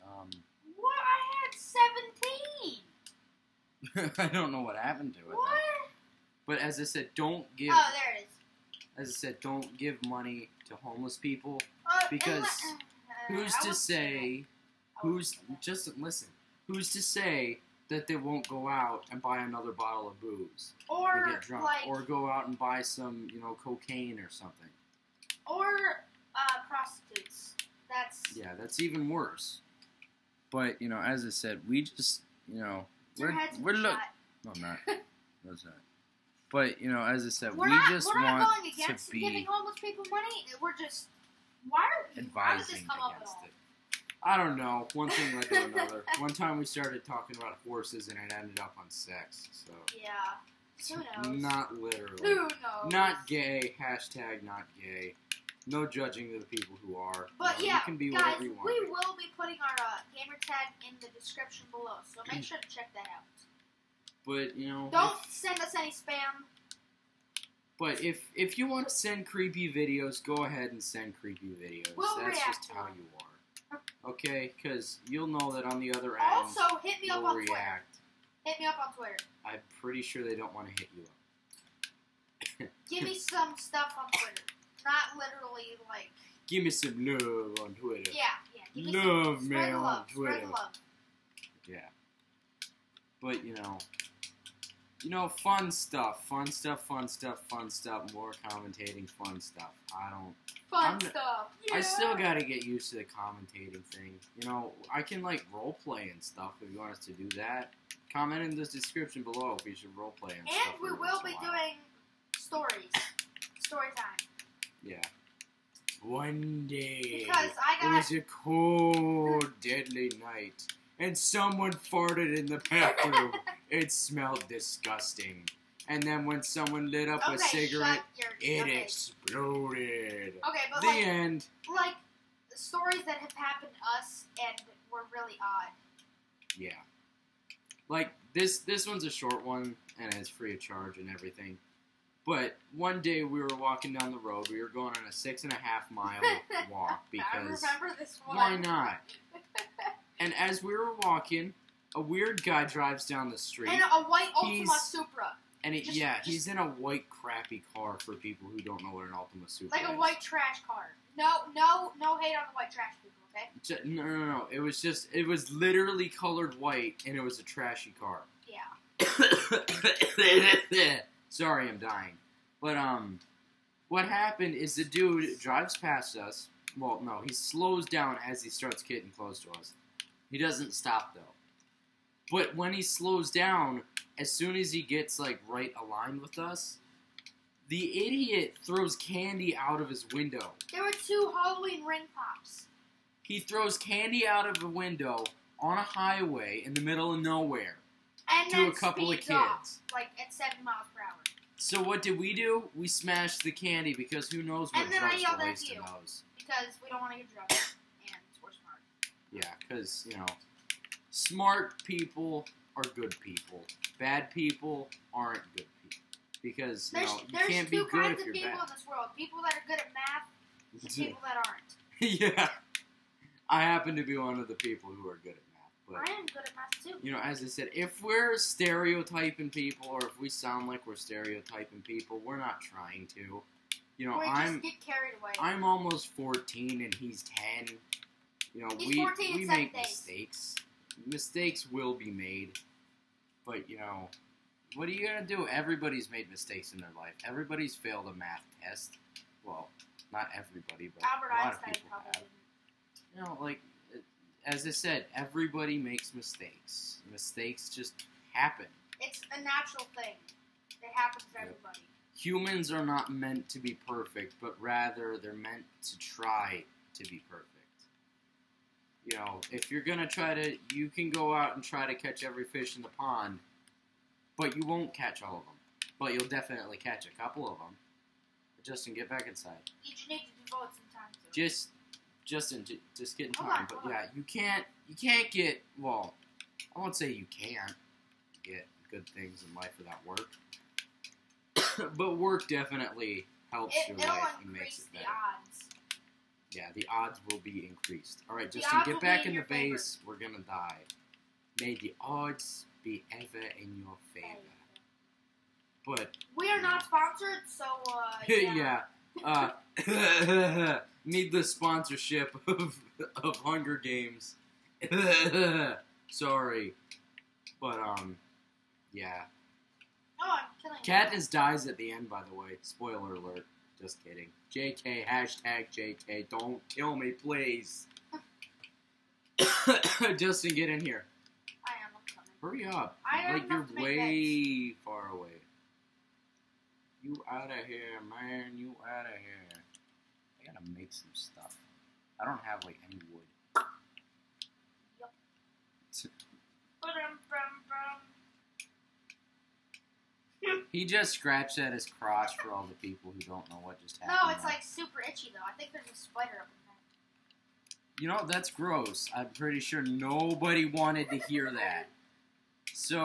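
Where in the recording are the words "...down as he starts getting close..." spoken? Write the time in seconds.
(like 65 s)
177 s.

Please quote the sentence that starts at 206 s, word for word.
because we don't want to get drunk, and we're smart.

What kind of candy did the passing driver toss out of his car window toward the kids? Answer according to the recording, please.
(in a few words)
Halloween ring pops.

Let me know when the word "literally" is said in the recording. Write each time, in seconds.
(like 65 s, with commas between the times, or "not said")
51 s, 85 s, 165 s.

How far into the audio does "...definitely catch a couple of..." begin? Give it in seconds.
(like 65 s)
276 s.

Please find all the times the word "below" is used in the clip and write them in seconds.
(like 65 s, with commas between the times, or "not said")
61 s, 109 s.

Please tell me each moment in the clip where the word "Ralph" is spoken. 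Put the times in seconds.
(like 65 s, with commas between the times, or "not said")
not said.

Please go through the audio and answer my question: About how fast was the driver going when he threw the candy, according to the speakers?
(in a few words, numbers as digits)
7 miles per hour.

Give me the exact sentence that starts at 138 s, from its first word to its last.
This one's a short one, and it's free of charge and everything.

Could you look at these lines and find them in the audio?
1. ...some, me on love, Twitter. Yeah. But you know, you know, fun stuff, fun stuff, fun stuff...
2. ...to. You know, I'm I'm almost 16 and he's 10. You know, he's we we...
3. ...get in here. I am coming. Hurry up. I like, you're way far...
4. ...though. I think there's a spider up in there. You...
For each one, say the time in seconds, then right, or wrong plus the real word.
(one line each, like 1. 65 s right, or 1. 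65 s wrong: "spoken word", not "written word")
1. 89 s right
2. 233 s wrong: "14", not "16"
3. 330 s right
4. 355 s right.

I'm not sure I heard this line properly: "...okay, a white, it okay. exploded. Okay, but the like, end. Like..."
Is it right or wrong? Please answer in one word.
wrong.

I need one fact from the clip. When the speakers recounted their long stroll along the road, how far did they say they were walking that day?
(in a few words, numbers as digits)
6.5 miles.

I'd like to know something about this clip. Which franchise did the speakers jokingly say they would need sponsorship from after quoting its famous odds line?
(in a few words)
Hunger Games.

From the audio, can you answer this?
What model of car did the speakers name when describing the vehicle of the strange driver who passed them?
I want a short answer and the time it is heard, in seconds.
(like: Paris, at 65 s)
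Ultima Supra, at 159 s.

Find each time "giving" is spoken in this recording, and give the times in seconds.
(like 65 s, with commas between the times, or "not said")
39 s.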